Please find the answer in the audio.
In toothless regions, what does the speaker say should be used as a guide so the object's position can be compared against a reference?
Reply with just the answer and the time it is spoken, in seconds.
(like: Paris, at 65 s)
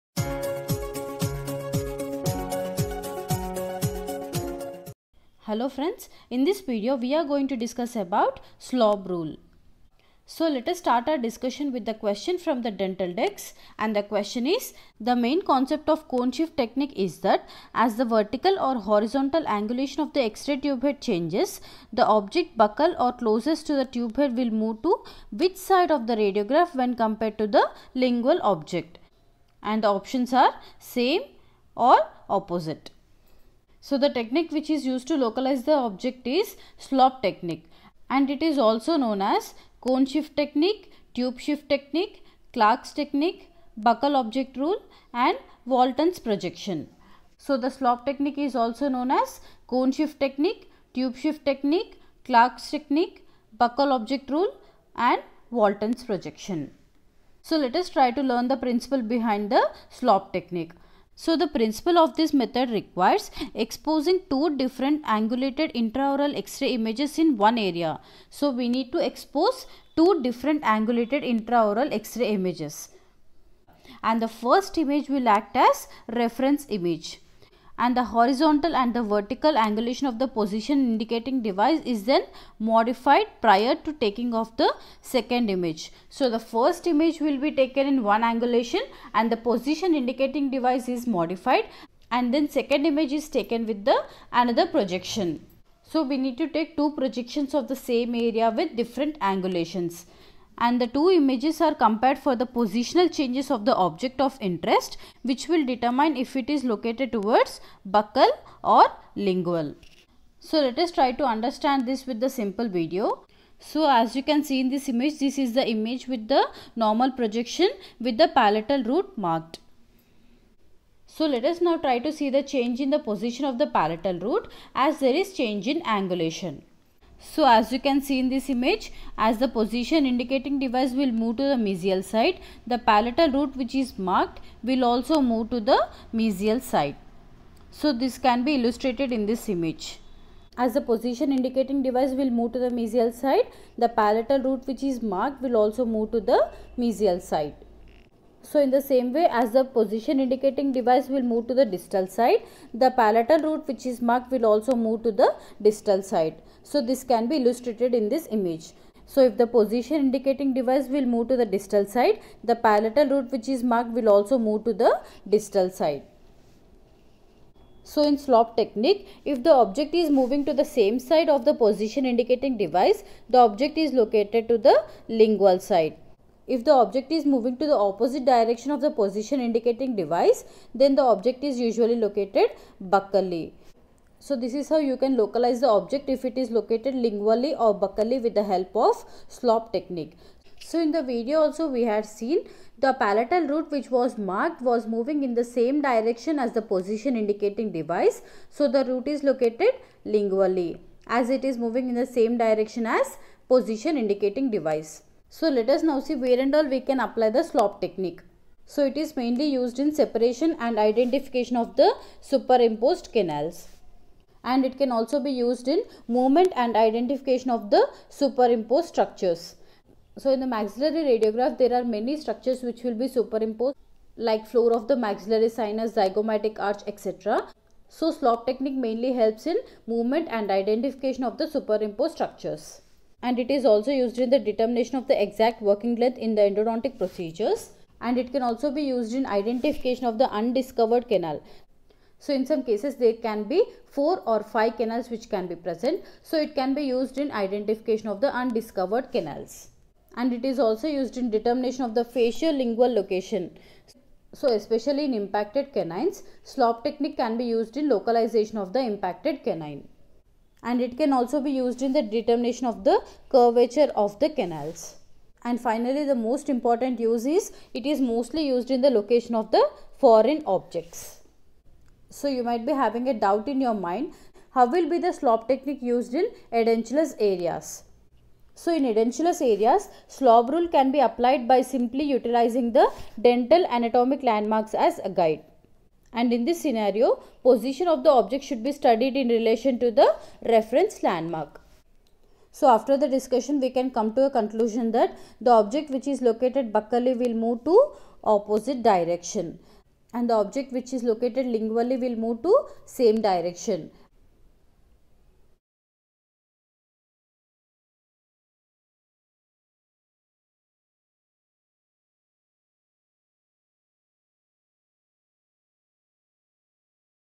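Dental anatomic landmarks, at 283 s.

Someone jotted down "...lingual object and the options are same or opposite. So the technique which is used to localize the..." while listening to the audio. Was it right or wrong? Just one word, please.
right.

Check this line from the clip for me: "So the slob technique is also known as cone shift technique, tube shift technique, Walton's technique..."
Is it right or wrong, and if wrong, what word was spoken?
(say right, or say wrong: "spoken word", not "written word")
wrong: "Clark", not "Walton".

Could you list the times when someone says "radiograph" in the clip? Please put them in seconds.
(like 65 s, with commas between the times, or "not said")
26 s, 221 s.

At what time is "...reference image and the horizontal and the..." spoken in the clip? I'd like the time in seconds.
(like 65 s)
76 s.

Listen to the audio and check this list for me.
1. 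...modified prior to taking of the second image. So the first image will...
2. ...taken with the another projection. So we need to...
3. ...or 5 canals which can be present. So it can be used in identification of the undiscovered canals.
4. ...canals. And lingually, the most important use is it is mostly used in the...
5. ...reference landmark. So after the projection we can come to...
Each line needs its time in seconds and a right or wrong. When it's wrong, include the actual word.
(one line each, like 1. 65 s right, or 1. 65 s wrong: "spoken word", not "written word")
1. 82 s right
2. 93 s right
3. 244 s right
4. 264 s wrong: "finally", not "lingually"
5. 290 s wrong: "discussion", not "projection".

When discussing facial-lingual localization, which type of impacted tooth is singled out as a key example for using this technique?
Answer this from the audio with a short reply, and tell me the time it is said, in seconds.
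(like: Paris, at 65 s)
Canines, at 255 s.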